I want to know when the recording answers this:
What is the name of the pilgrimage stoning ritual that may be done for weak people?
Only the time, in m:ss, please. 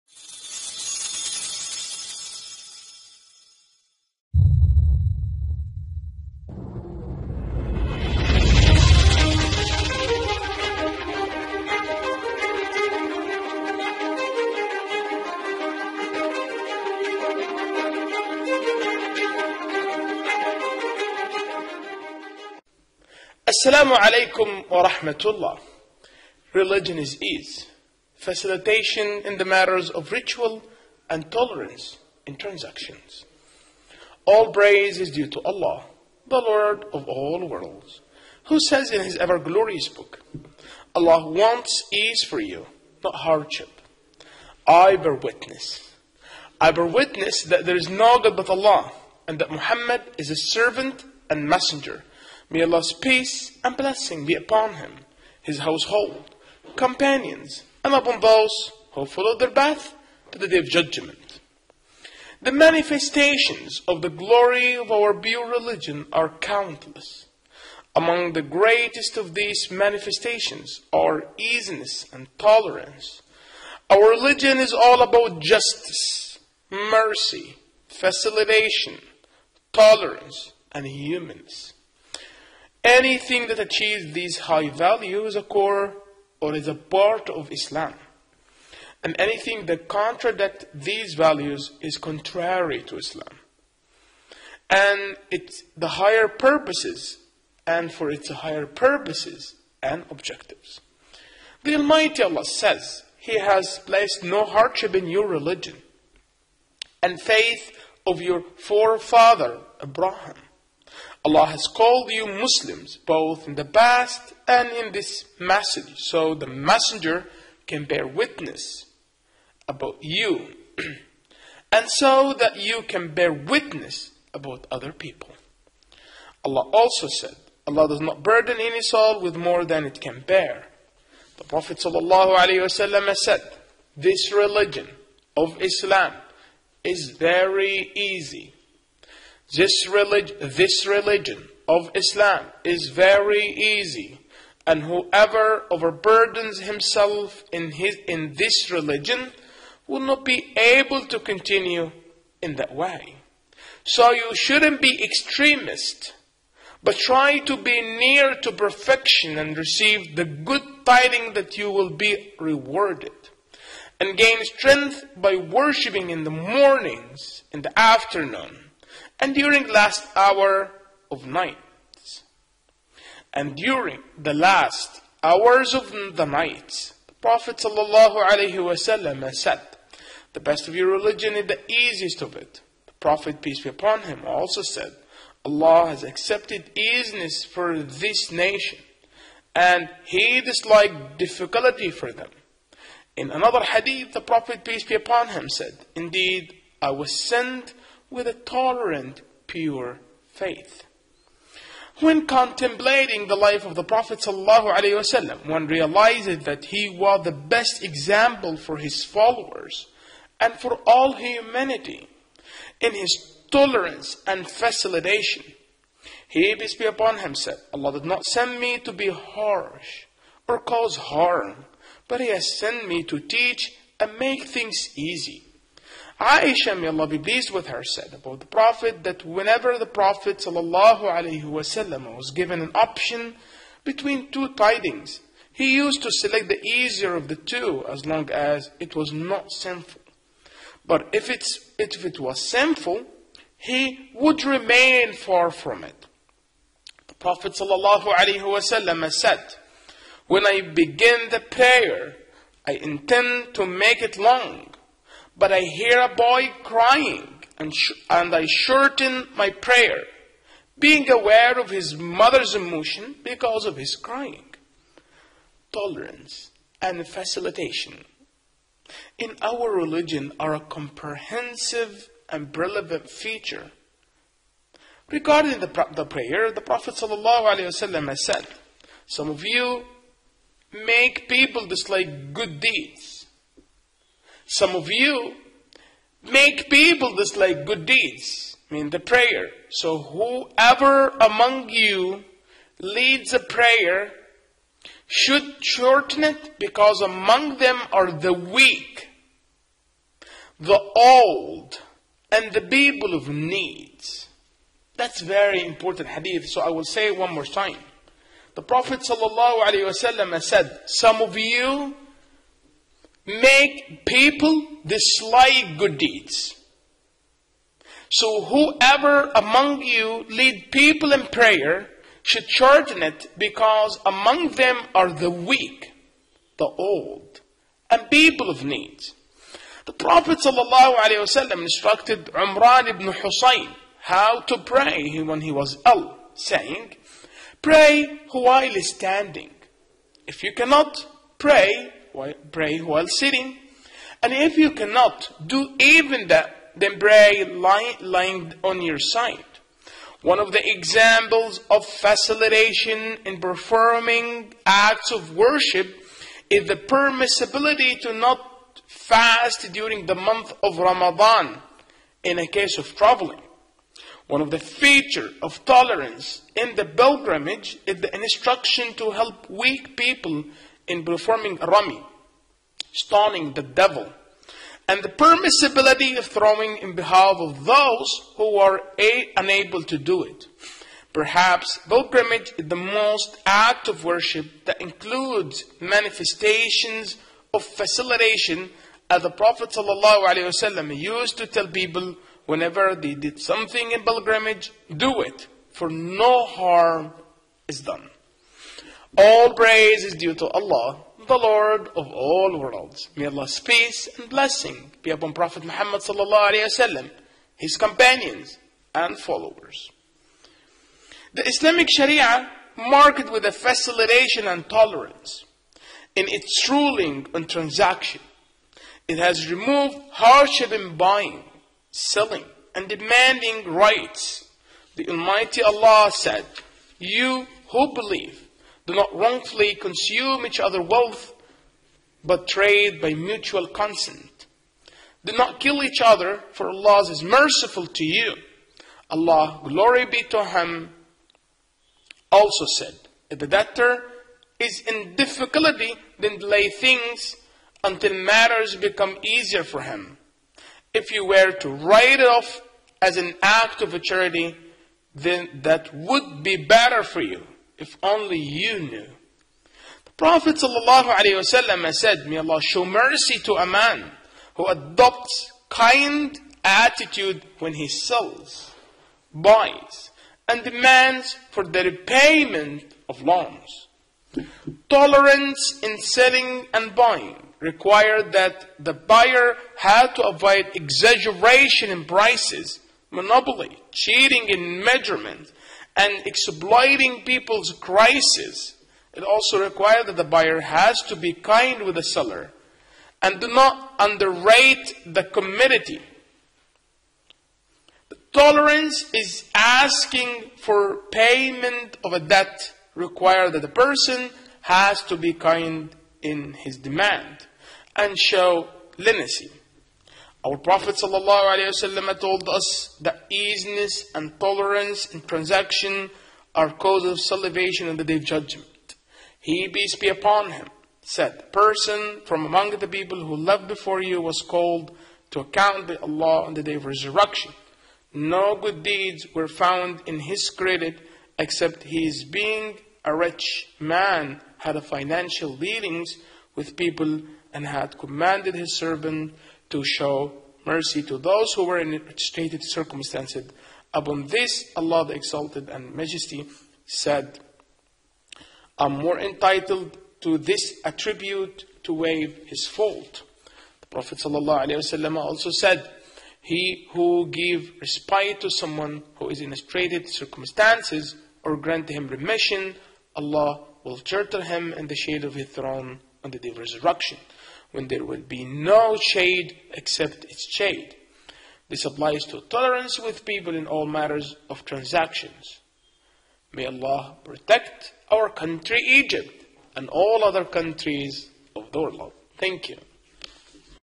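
6:11.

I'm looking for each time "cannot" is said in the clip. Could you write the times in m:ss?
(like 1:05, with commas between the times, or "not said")
5:40, 5:44.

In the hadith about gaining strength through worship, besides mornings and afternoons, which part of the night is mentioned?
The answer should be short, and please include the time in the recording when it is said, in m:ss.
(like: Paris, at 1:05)
The last hours of the night, at 2:54.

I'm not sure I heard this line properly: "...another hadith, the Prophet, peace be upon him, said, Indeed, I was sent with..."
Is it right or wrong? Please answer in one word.
right.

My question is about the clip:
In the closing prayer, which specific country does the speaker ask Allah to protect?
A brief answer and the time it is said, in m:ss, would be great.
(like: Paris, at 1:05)
Egypt, at 9:38.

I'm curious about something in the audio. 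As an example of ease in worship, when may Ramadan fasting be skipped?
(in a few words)
Traveling.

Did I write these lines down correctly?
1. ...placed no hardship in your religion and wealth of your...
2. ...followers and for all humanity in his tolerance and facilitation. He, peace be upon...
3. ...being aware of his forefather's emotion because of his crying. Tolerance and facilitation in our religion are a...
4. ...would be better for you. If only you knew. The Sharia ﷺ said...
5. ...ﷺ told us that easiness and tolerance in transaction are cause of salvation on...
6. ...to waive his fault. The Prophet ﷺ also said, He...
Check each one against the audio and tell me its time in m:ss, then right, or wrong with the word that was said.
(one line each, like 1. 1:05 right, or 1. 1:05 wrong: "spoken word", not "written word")
1. 1:43 wrong: "faith", not "wealth"
2. 3:29 right
3. 4:20 wrong: "mother", not "forefather"
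4. 7:35 wrong: "Prophet", not "Sharia"
5. 8:30 right
6. 9:11 right.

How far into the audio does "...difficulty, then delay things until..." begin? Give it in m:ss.
7:25.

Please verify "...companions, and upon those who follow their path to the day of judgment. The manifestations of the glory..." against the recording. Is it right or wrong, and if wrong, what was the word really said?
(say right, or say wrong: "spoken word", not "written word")
right.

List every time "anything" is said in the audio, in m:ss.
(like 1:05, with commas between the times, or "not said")
1:22, 1:29.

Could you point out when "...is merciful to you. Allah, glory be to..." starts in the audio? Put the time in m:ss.
7:17.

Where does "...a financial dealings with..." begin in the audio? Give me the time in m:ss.
8:54.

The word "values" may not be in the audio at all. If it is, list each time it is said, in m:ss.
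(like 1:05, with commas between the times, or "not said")
1:24, 1:31.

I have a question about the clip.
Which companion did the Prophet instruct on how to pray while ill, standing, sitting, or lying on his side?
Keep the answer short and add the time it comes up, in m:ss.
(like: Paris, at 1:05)
Umran ibn Husayn, at 5:32.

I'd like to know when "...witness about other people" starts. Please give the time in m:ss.
2:03.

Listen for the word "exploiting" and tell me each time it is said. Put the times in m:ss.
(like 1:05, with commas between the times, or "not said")
8:06.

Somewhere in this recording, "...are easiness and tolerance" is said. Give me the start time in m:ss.
1:10.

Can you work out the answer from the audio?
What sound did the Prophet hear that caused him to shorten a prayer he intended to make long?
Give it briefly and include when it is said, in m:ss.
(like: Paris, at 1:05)
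A boy crying, at 4:16.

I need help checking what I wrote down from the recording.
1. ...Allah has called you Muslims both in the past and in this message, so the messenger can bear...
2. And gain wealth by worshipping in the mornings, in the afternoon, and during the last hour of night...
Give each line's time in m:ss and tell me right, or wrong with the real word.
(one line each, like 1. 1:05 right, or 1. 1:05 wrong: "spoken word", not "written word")
1. 1:51 right
2. 2:43 wrong: "strength", not "wealth".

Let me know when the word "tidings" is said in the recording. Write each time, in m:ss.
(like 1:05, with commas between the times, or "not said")
2:40, 3:54.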